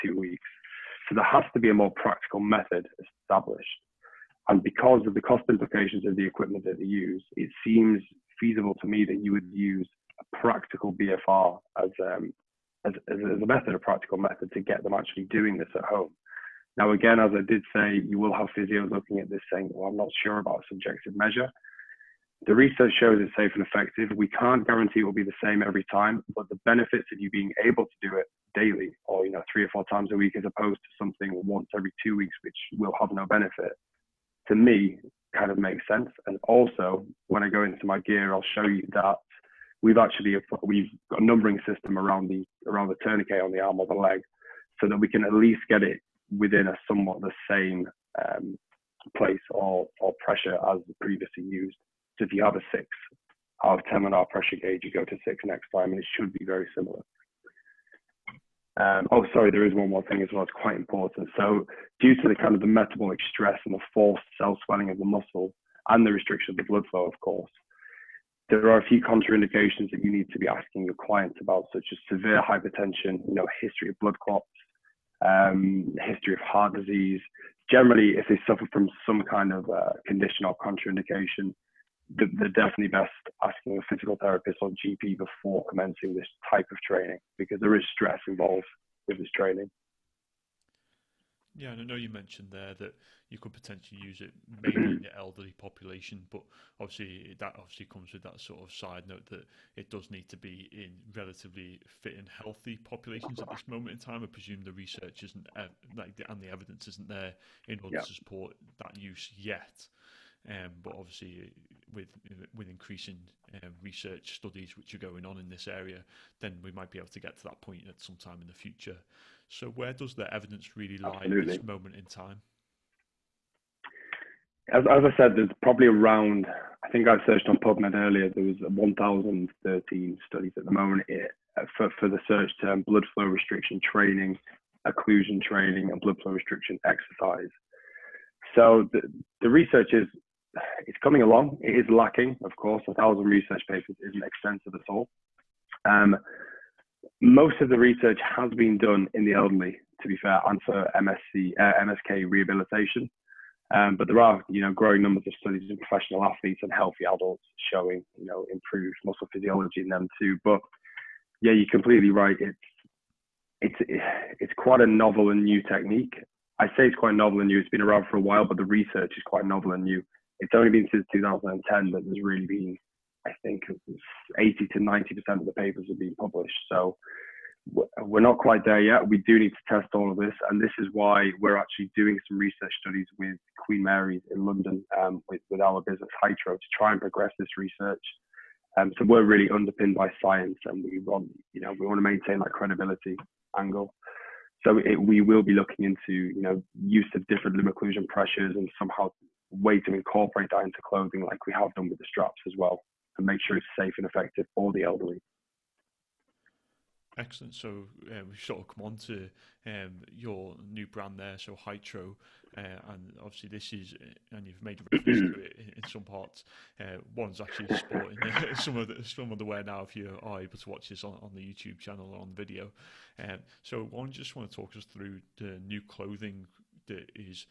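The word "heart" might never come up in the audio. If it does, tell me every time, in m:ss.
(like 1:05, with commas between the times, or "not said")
1:16.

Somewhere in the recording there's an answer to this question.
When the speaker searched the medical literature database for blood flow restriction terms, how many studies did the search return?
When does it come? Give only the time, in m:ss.
2:08.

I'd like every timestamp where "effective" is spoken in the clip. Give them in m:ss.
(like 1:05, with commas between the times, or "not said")
0:23, 3:24.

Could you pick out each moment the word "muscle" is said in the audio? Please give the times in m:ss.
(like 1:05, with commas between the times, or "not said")
1:05, 2:39.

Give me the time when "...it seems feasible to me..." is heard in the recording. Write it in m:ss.
0:07.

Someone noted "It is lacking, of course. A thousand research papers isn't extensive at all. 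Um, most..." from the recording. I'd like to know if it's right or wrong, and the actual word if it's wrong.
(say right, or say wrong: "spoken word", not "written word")
right.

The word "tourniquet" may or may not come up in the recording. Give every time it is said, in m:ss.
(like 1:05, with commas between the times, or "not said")
0:43.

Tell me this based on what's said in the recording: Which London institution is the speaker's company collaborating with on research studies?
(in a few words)
Queen Mary's.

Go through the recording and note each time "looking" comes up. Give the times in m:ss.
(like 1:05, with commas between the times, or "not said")
0:18, 3:15.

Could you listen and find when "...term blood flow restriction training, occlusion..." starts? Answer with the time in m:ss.
2:12.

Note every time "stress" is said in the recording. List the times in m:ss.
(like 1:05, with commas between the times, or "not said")
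1:03, 1:27.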